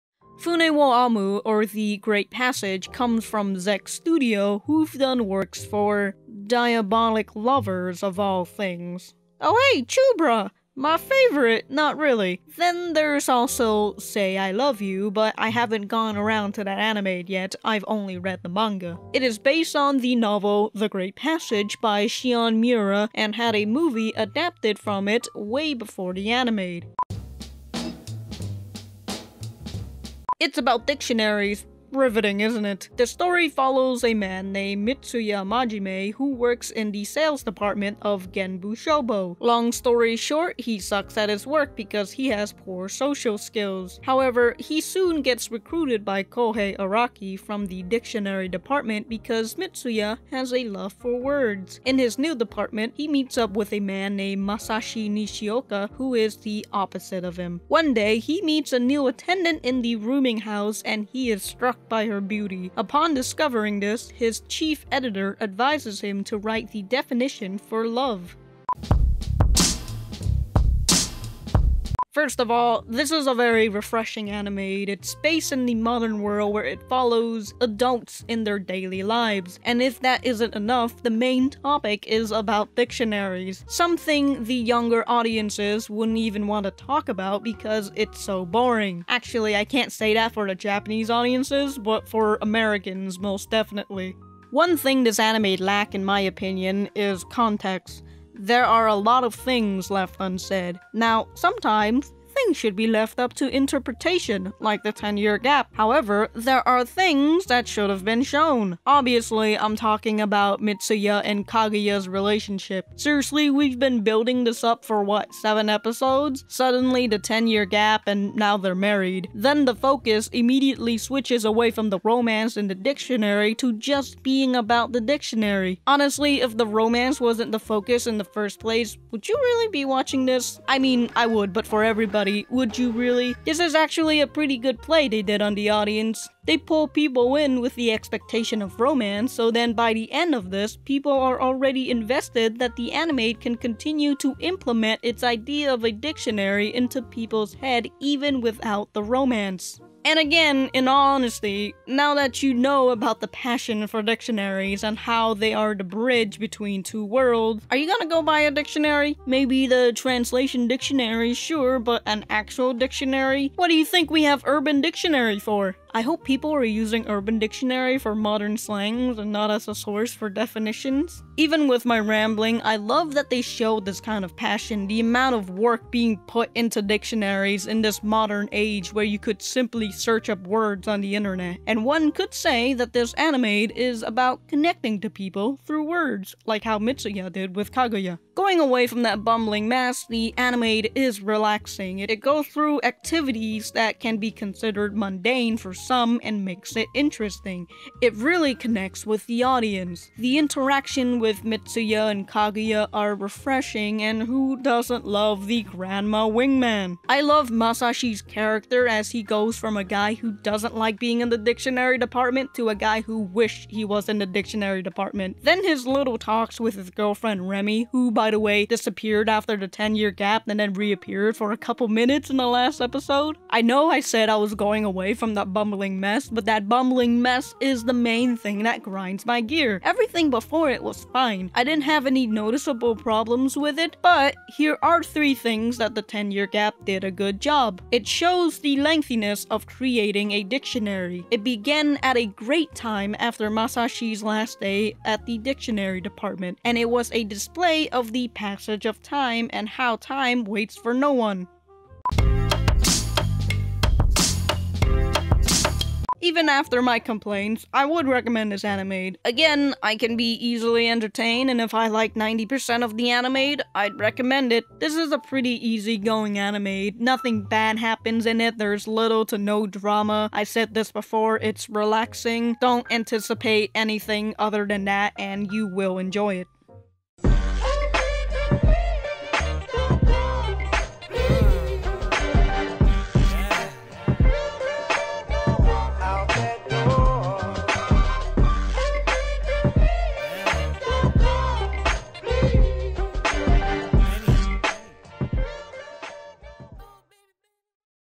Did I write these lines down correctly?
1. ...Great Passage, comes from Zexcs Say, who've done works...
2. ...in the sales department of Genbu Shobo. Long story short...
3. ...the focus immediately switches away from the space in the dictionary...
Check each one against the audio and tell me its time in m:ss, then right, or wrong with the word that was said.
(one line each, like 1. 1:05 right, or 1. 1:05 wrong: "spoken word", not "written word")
1. 0:01 wrong: "Studio", not "Say"
2. 0:36 right
3. 1:59 wrong: "romance", not "space".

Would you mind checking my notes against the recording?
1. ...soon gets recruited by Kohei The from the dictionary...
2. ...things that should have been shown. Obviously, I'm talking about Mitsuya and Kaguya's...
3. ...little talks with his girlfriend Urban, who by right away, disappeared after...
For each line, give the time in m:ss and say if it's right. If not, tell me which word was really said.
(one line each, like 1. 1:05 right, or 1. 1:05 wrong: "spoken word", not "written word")
1. 0:44 wrong: "Araki", not "The"
2. 1:46 right
3. 3:35 wrong: "Remy", not "Urban".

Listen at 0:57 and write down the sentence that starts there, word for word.
One day, he meets a new attendant in the rooming house and he is struck by her beauty.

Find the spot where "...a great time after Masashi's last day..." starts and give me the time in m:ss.
4:02.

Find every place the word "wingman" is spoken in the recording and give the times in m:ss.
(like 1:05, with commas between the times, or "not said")
3:26.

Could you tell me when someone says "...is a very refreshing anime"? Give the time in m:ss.
1:13.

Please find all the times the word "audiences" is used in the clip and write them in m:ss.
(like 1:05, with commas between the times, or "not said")
1:25, 1:31, 2:15, 3:19.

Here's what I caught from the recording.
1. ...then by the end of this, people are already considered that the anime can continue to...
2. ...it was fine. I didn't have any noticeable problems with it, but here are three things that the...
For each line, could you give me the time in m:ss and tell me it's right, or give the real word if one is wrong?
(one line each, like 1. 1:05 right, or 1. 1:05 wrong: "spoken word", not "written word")
1. 2:19 wrong: "invested", not "considered"
2. 3:50 right.